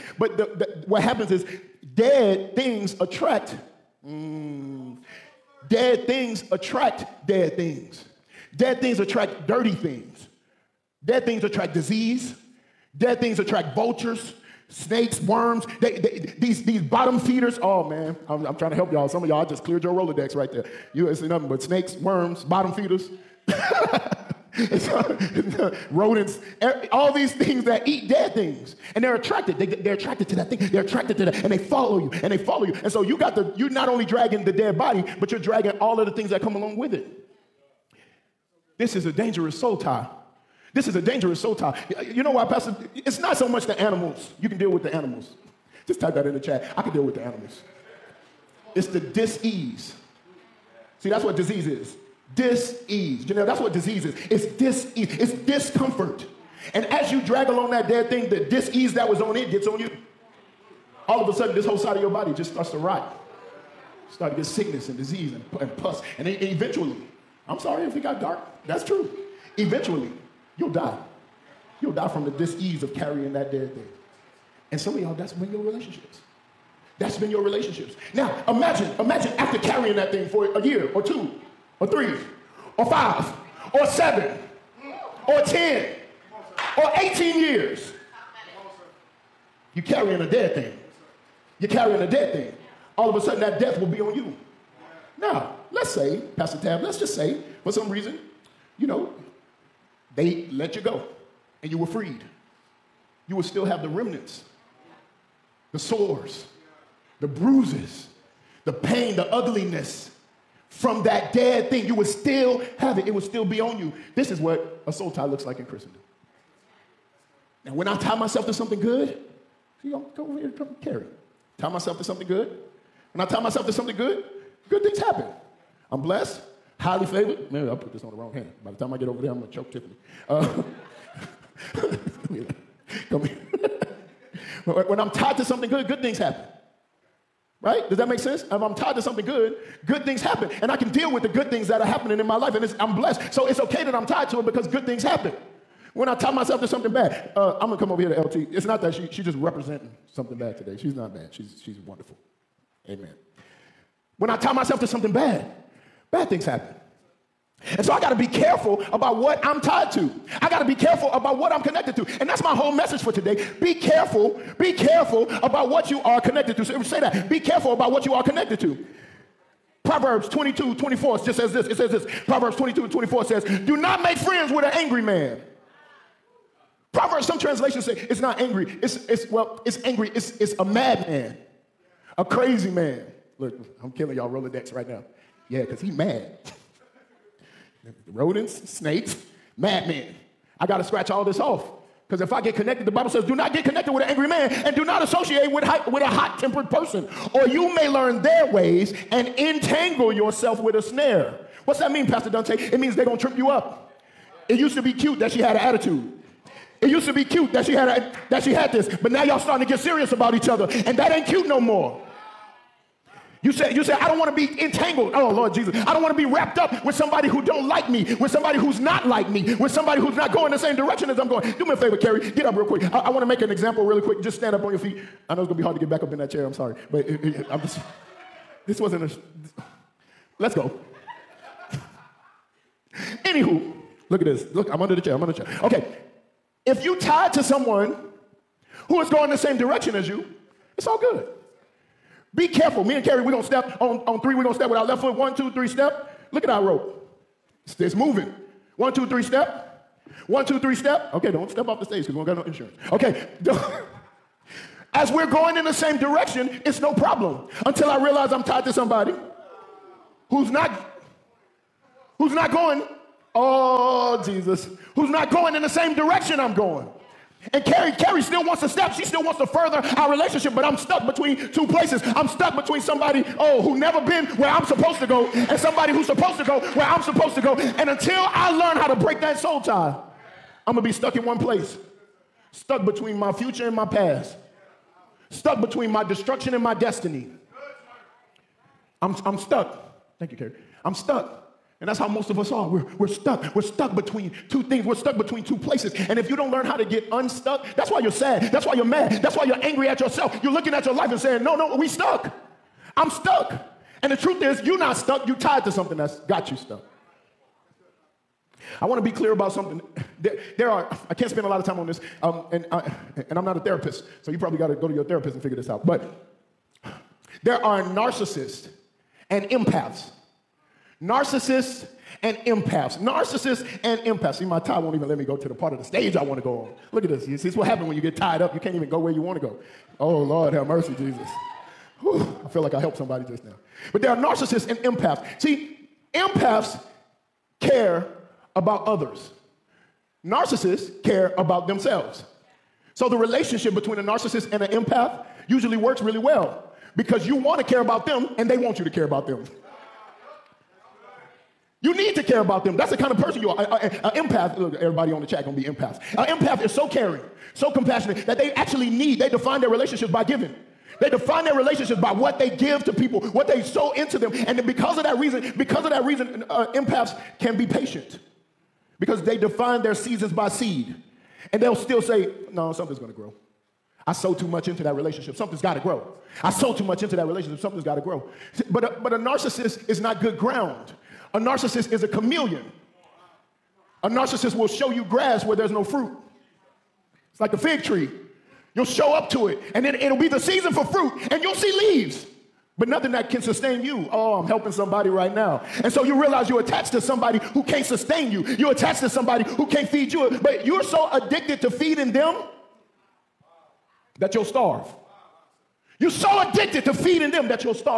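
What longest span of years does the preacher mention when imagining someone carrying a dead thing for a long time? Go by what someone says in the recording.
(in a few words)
18 years.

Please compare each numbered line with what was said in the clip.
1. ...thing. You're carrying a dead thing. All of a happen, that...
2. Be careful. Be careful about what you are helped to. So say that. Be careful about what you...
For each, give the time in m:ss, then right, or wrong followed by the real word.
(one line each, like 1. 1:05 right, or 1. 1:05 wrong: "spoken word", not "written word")
1. 1:30 wrong: "sudden", not "happen"
2. 2:43 wrong: "connected", not "helped".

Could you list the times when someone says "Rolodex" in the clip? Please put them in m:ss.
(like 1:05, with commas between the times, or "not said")
0:19, 3:04.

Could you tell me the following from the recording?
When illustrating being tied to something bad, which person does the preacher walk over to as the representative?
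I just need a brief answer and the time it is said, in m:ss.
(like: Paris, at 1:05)
LT, at 2:28.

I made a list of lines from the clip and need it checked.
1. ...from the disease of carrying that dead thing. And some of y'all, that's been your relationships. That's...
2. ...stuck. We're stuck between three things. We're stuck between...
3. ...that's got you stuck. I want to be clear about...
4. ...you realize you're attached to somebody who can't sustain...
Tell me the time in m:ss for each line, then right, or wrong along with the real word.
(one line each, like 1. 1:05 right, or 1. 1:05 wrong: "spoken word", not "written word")
1. 1:12 right
2. 4:53 wrong: "two", not "three"
3. 5:05 right
4. 6:36 right.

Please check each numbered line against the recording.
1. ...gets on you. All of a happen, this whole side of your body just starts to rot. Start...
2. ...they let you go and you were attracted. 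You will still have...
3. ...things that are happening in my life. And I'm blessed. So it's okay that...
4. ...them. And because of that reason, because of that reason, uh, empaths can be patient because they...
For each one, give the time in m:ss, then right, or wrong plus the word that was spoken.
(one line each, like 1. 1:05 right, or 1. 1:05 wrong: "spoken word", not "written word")
1. 0:59 wrong: "sudden", not "happen"
2. 1:40 wrong: "freed", not "attracted"
3. 2:21 right
4. 6:04 right.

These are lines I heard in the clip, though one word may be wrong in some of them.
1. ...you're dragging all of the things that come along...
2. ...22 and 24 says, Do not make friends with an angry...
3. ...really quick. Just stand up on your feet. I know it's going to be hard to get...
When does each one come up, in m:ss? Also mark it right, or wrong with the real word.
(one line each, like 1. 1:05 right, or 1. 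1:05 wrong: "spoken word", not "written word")
1. 0:35 right
2. 2:52 right
3. 3:43 right.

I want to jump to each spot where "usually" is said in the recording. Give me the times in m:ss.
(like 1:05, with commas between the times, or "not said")
5:45.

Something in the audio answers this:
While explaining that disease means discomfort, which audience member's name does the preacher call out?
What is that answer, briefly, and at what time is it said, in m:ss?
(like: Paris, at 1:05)
Janelle, at 0:53.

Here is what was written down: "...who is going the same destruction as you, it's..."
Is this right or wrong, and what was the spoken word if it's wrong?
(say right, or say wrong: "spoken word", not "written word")
wrong: "direction", not "destruction".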